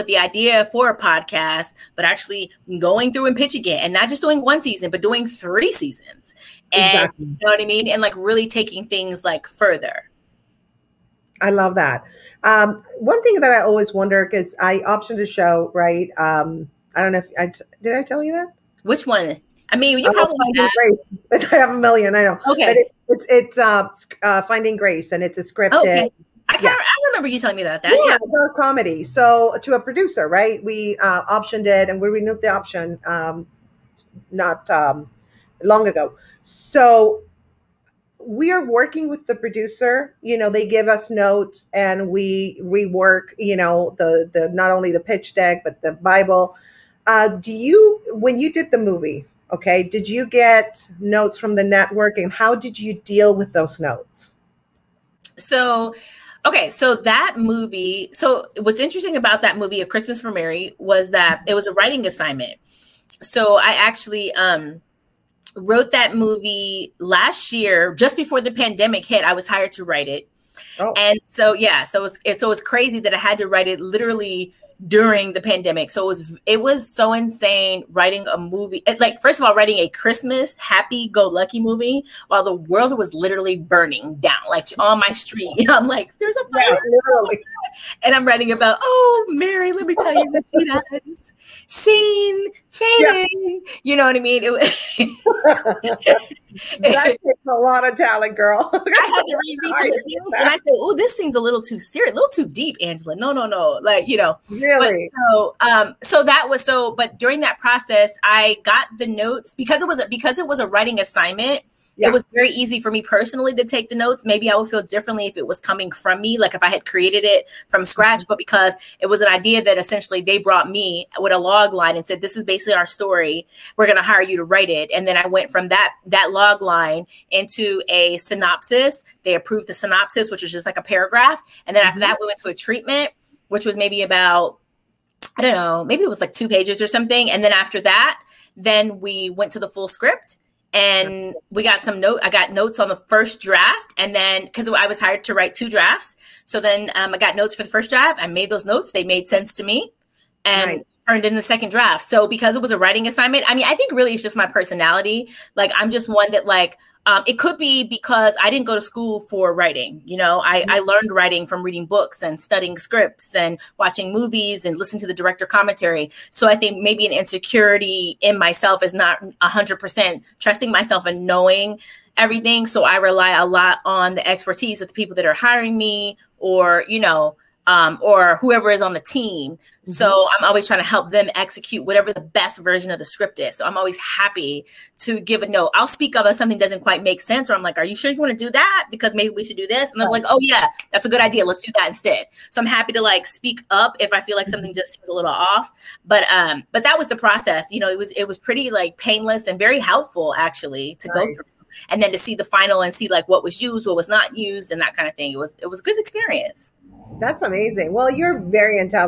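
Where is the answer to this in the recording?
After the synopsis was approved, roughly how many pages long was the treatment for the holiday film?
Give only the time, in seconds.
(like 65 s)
136 s.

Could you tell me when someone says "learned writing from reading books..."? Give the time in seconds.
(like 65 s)
160 s.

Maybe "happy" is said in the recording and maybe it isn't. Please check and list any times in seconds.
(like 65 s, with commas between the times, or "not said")
80 s, 183 s, 192 s.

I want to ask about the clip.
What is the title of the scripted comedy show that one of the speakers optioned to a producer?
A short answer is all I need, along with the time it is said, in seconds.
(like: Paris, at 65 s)
Finding Grace, at 24 s.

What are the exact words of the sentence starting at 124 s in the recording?
And then I went from that, that log line into a synopsis.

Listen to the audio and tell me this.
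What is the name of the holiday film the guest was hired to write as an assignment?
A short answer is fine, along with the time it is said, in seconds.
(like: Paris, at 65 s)
A Christmas for Mary, at 59 s.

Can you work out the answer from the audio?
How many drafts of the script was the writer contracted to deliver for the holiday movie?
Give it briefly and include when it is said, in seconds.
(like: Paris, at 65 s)
2, at 145 s.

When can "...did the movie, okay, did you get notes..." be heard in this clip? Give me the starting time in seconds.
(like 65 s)
48 s.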